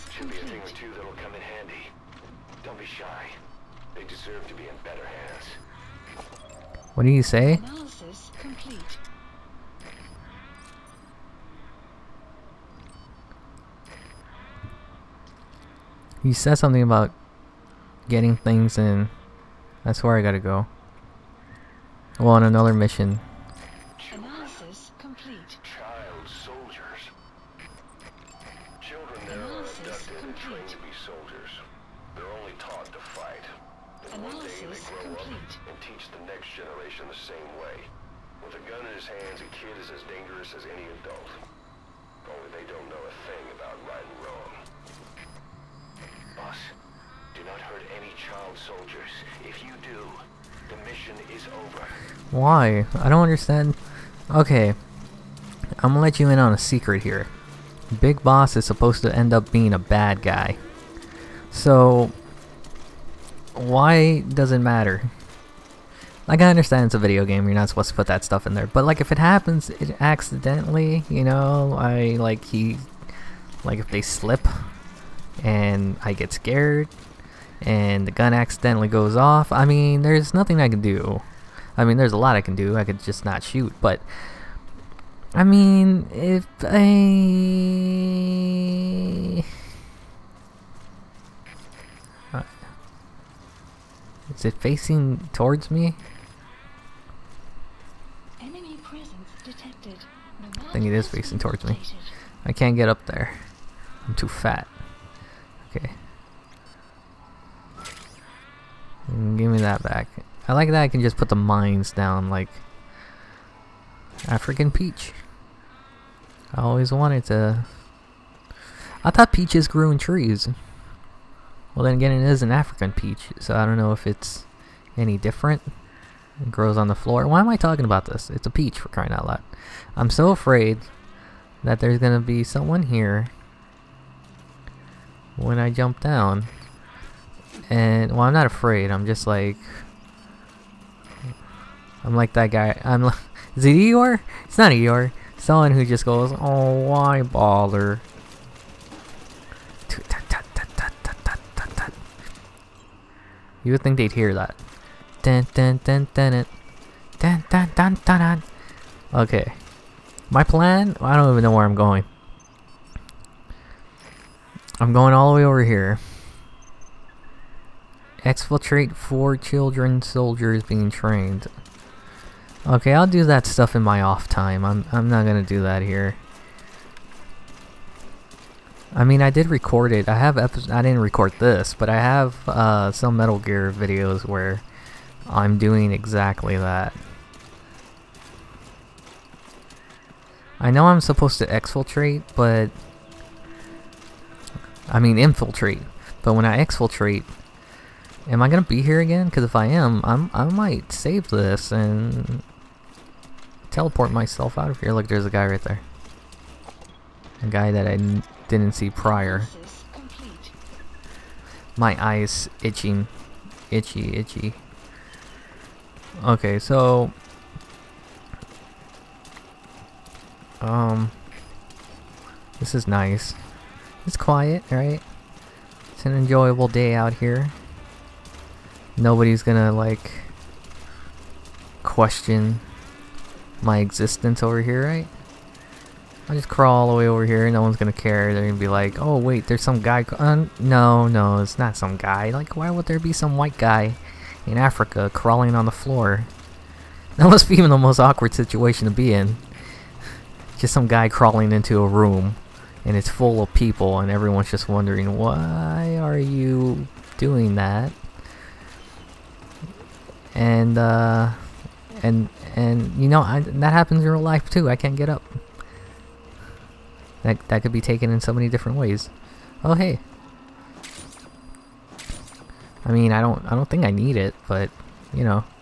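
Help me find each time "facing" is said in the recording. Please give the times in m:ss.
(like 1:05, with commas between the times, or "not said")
1:34, 1:41.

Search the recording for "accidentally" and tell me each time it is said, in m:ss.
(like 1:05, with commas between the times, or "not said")
1:10, 1:18.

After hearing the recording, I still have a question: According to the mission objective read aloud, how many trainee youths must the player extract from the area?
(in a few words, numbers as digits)
4.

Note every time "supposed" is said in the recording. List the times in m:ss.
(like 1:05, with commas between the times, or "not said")
0:58, 1:07, 3:10.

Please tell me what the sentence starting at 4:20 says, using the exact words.
And, uh, and, and, you know, I, that happens in real life too.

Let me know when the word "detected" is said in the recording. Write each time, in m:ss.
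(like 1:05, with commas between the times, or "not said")
1:39.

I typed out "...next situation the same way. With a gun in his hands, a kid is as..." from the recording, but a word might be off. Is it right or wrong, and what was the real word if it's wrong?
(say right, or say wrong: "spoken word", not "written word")
wrong: "generation", not "situation".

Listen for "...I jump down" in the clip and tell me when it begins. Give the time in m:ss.
2:15.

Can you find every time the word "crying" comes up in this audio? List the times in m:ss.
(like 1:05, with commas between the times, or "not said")
2:08.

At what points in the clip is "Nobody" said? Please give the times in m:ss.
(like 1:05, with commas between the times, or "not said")
3:48.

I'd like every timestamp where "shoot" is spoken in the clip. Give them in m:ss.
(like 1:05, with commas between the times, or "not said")
1:23.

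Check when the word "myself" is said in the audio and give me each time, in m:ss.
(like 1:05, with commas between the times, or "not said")
3:24.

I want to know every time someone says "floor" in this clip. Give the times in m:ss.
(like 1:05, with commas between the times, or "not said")
2:06, 4:05.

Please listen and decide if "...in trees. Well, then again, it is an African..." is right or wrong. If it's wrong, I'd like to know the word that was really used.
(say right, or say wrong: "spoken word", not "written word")
right.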